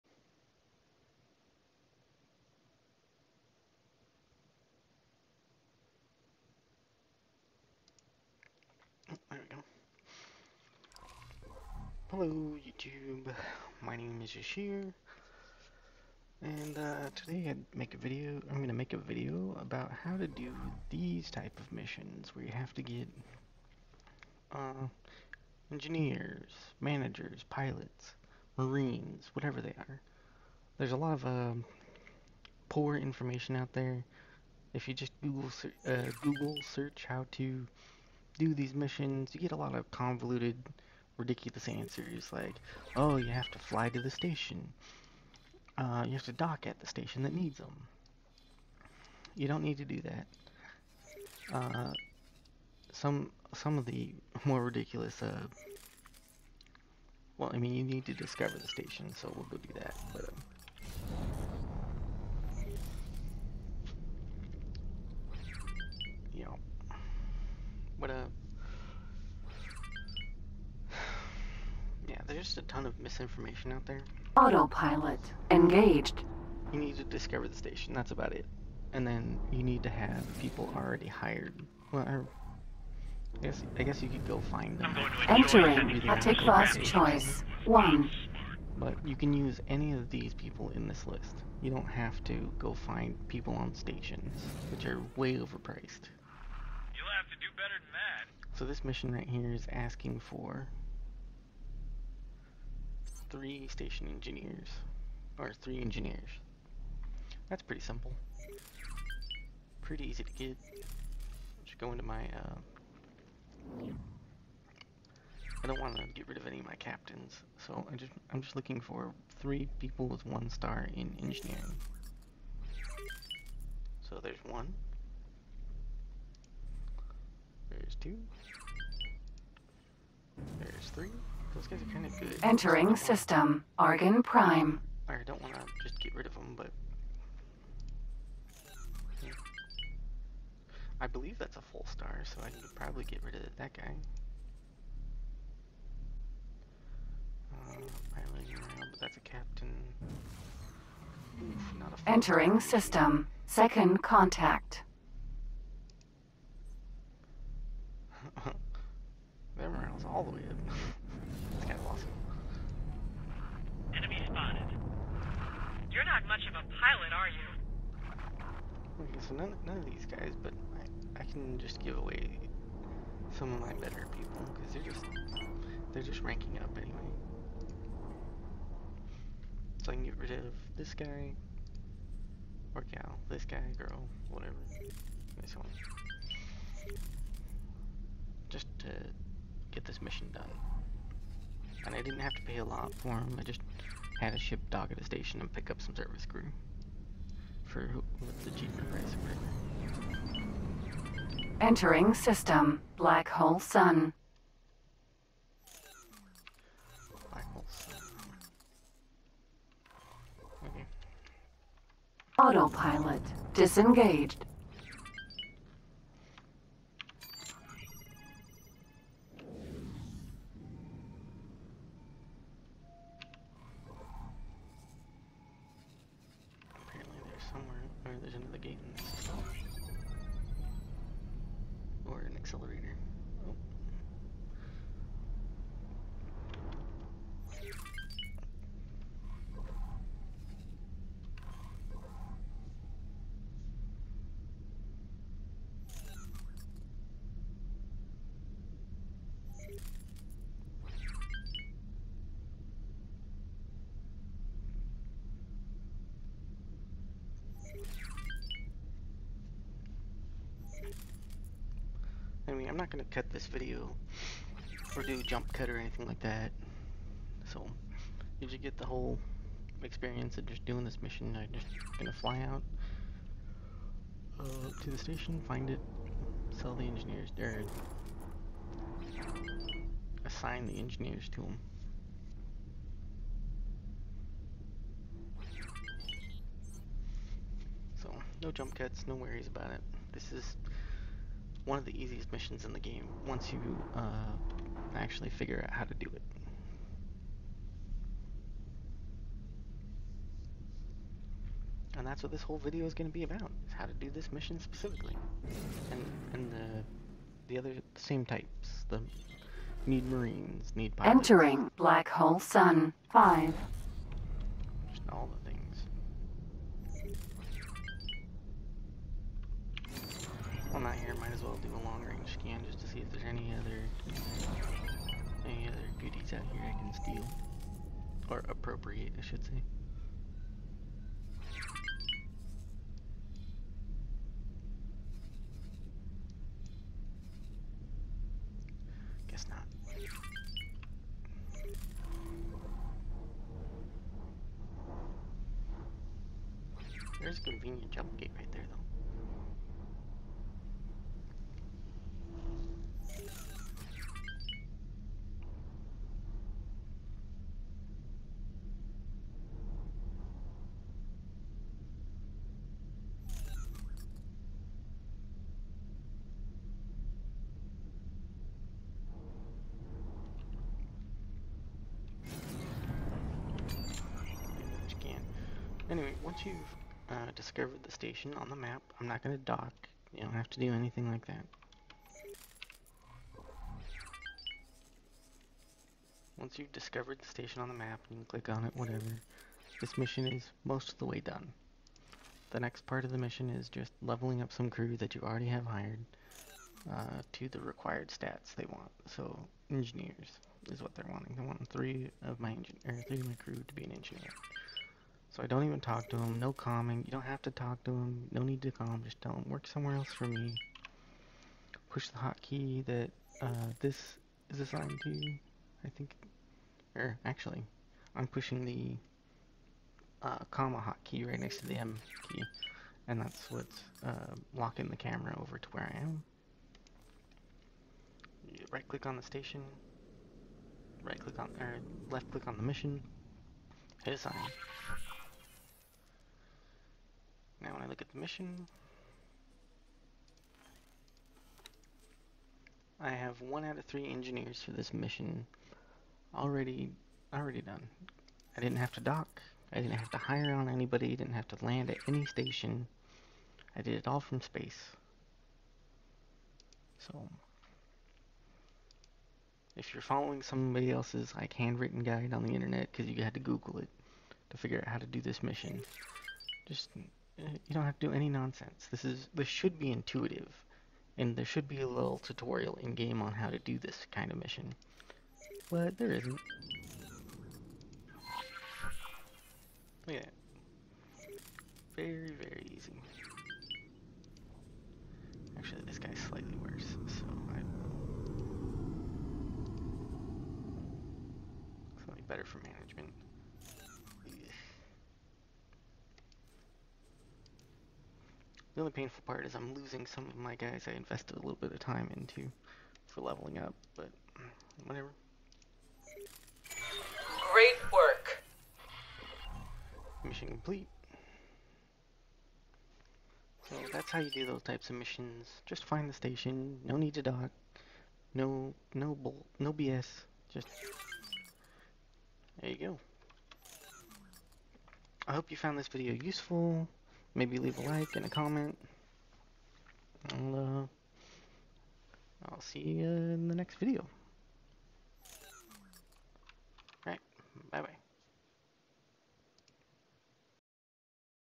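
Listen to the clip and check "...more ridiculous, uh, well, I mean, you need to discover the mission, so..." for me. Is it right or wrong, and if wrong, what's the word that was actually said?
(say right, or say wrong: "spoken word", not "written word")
wrong: "station", not "mission".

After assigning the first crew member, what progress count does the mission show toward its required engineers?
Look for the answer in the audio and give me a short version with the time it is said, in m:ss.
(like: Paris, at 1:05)
1 out of 3, at 7:23.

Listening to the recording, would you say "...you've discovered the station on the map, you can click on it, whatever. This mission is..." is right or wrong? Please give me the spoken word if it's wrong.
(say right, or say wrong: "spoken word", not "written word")
right.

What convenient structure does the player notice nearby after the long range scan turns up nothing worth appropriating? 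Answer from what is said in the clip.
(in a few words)
jump gate.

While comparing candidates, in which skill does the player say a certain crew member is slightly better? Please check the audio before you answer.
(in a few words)
management.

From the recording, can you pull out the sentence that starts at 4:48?
So, no jump cuts, no worries about it.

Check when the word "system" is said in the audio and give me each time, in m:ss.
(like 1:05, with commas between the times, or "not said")
2:12, 2:32, 3:22.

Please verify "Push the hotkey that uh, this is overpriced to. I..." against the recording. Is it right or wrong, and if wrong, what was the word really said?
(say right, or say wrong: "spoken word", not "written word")
wrong: "assigned", not "overpriced".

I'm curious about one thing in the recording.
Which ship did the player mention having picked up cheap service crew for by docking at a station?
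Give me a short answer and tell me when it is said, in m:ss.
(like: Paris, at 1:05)
G Enterprise, at 3:18.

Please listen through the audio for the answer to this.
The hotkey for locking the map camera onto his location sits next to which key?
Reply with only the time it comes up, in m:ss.
7:01.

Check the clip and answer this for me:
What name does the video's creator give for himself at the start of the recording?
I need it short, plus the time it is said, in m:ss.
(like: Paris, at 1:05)
Eshir, at 0:14.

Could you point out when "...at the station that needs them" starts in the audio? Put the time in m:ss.
0:46.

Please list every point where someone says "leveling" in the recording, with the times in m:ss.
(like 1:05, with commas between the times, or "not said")
6:34, 8:23.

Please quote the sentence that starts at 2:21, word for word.
I believe that's a full star, so I need to probably get rid of that guy.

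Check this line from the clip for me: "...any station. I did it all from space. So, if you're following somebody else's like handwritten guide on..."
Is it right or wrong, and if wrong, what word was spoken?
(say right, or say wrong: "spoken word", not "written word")
right.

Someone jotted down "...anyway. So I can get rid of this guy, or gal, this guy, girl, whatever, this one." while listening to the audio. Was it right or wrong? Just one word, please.
right.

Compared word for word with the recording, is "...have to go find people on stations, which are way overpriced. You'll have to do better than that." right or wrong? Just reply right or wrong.
right.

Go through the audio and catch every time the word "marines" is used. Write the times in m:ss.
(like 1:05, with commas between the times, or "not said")
0:28, 5:10.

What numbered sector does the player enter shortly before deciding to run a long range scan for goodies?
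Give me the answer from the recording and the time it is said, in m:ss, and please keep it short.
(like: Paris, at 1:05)
Black Hole Sun 5, at 5:11.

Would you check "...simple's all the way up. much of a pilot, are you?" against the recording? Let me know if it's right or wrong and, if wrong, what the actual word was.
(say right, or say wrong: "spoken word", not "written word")
wrong: "morale", not "simple".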